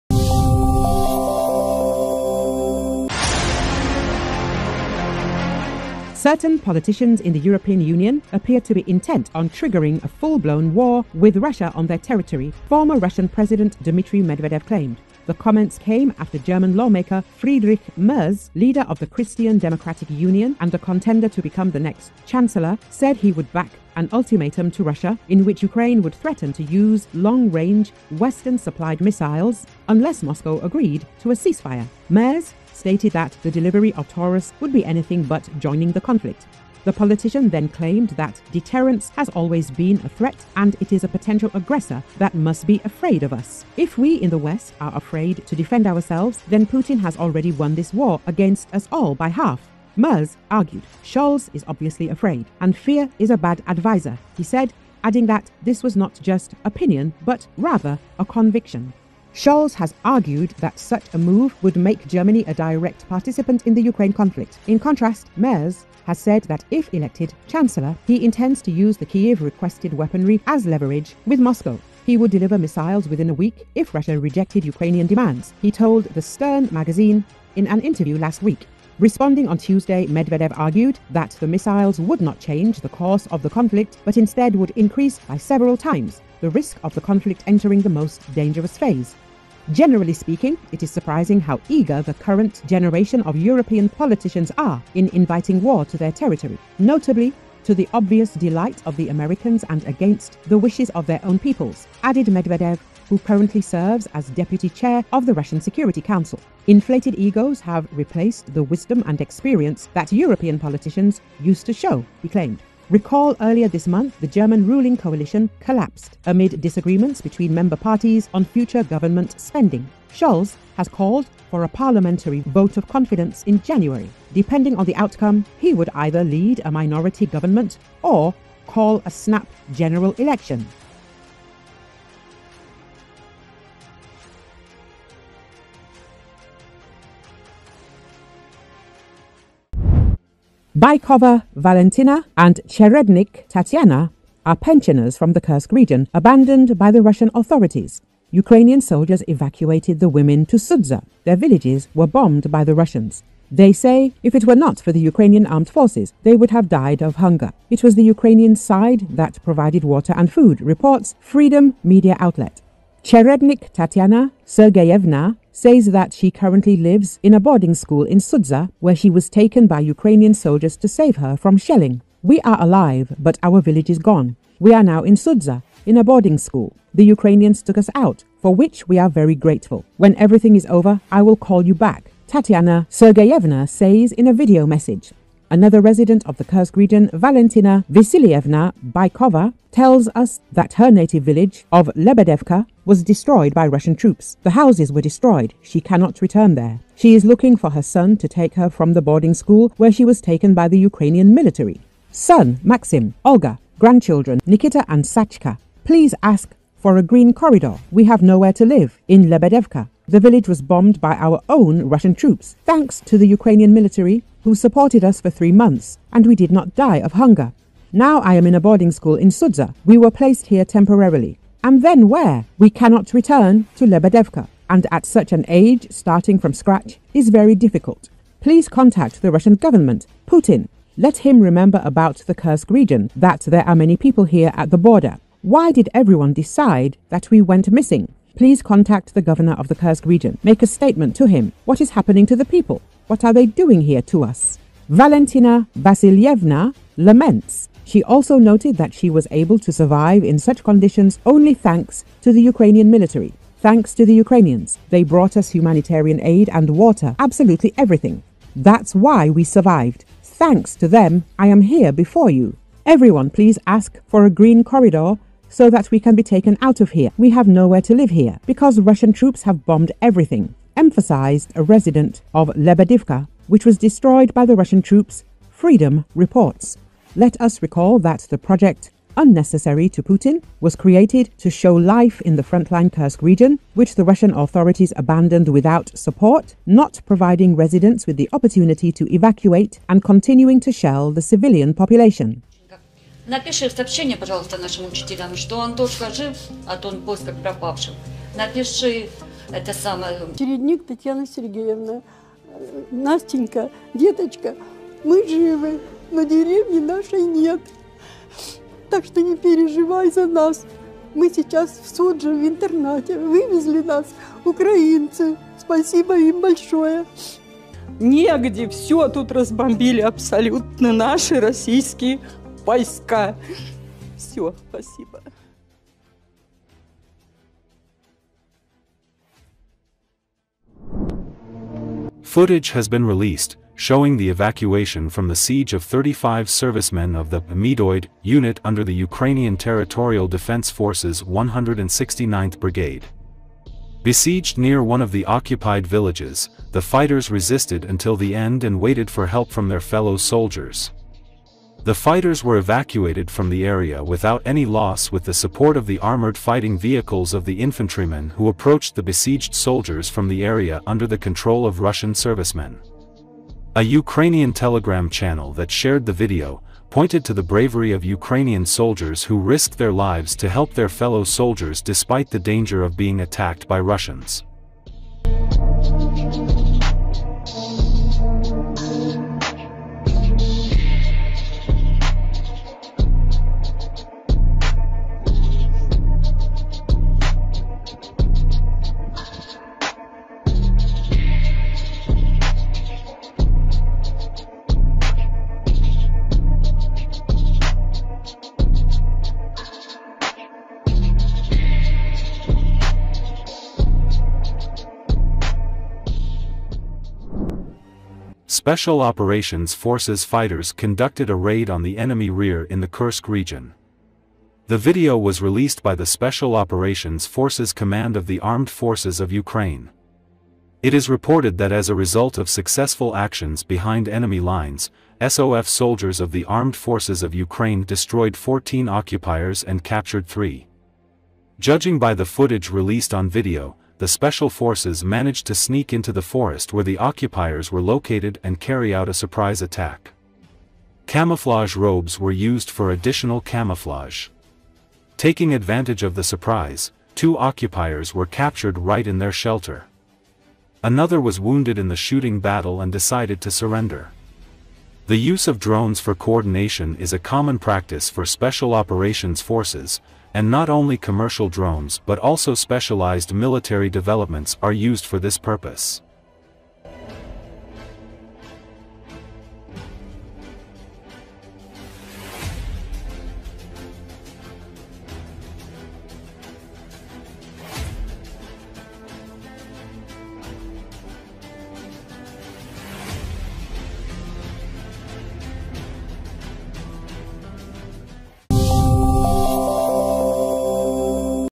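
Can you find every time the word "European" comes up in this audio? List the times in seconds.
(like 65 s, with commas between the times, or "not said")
7 s, 93 s, 110 s.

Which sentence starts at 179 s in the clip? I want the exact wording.
When everything is over, I will call you back.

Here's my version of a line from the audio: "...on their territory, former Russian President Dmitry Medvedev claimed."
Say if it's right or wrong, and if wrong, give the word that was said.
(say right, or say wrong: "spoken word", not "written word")
right.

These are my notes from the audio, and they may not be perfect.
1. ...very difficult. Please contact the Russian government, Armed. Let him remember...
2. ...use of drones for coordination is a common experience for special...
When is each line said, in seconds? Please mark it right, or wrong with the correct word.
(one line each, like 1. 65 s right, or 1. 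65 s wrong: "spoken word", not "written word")
1. 227 s wrong: "Putin", not "Armed"
2. 455 s wrong: "practice", not "experience".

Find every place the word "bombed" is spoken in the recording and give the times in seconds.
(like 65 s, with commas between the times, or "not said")
152 s, 210 s, 269 s.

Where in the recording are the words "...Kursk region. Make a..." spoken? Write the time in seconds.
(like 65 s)
239 s.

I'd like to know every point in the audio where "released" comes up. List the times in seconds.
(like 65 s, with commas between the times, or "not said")
333 s, 415 s, 432 s.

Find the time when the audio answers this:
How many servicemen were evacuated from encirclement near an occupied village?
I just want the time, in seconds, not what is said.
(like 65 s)
335 s.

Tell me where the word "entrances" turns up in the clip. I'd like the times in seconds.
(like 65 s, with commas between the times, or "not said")
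not said.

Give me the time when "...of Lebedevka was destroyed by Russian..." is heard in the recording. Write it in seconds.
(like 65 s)
191 s.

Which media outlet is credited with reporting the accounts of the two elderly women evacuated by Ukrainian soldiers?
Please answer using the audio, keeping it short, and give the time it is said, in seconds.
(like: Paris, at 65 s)
Freedom Media Outlet, at 161 s.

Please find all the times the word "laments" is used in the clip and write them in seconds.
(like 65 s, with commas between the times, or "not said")
246 s.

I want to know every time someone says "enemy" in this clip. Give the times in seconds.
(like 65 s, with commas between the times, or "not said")
411 s, 424 s.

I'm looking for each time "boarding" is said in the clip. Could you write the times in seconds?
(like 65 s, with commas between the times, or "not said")
167 s, 176 s, 199 s, 218 s.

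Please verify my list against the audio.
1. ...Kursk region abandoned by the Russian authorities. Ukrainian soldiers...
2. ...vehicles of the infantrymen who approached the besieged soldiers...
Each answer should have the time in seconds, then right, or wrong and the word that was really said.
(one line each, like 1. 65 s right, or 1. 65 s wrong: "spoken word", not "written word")
1. 145 s right
2. 356 s right.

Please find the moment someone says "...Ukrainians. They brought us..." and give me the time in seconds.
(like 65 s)
254 s.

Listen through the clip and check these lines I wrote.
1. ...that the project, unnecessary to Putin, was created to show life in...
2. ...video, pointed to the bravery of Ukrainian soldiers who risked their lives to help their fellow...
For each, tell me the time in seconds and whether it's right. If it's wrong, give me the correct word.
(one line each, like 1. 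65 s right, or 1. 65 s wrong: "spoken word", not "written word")
1. 278 s right
2. 366 s right.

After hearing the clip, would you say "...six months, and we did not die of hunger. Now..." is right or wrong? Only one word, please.
wrong.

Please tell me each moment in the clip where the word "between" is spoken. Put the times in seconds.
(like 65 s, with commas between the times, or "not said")
117 s.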